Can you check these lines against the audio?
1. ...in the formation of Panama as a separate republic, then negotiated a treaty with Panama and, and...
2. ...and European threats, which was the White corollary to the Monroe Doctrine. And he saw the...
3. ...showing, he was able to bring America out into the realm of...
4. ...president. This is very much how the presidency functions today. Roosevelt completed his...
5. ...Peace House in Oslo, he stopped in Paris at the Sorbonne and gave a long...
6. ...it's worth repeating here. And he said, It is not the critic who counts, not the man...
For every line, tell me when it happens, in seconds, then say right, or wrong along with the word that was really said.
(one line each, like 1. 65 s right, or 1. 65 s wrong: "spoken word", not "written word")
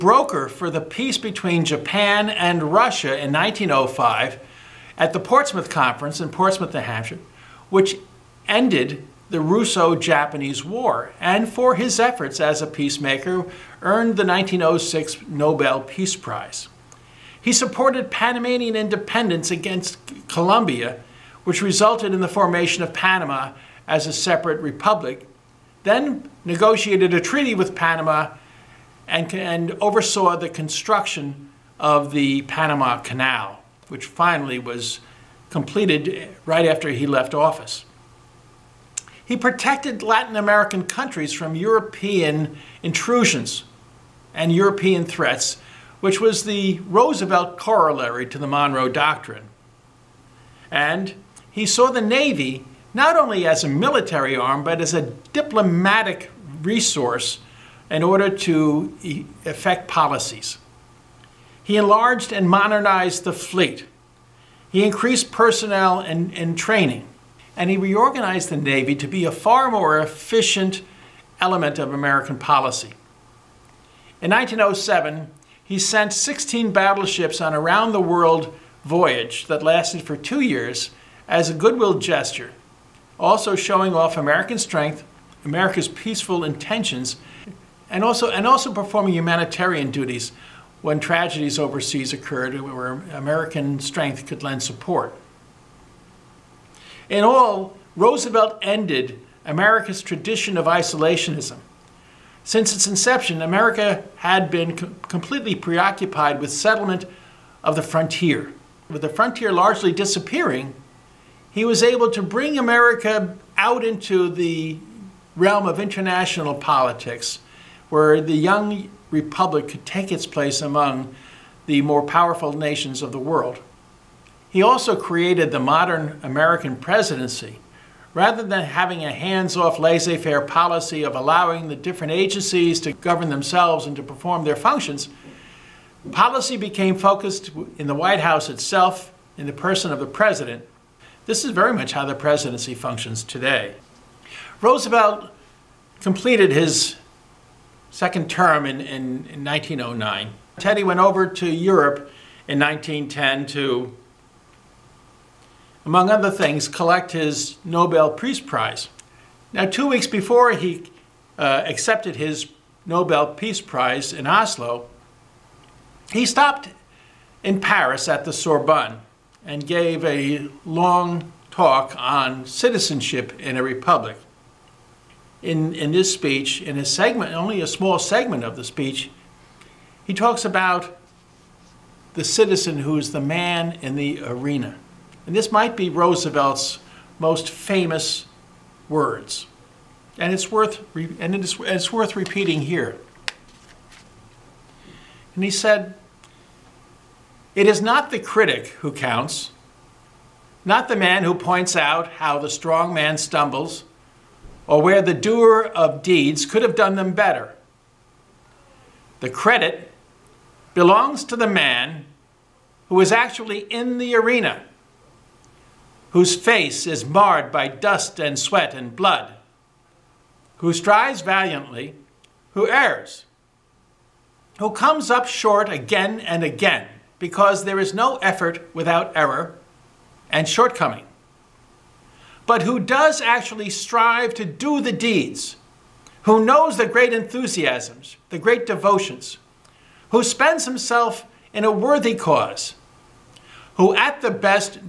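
1. 22 s right
2. 44 s wrong: "Roosevelt", not "White"
3. 109 s wrong: "disappearing", not "showing"
4. 140 s right
5. 163 s wrong: "Prize", not "House"
6. 191 s right.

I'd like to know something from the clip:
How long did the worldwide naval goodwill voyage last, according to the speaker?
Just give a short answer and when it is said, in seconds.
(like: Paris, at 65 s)
2 years, at 80 s.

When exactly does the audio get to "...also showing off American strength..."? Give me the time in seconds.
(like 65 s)
83 s.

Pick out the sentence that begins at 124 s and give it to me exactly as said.
He also created the modern American presidency.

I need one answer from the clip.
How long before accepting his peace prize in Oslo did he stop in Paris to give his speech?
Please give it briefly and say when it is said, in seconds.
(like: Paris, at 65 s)
2 weeks, at 159 s.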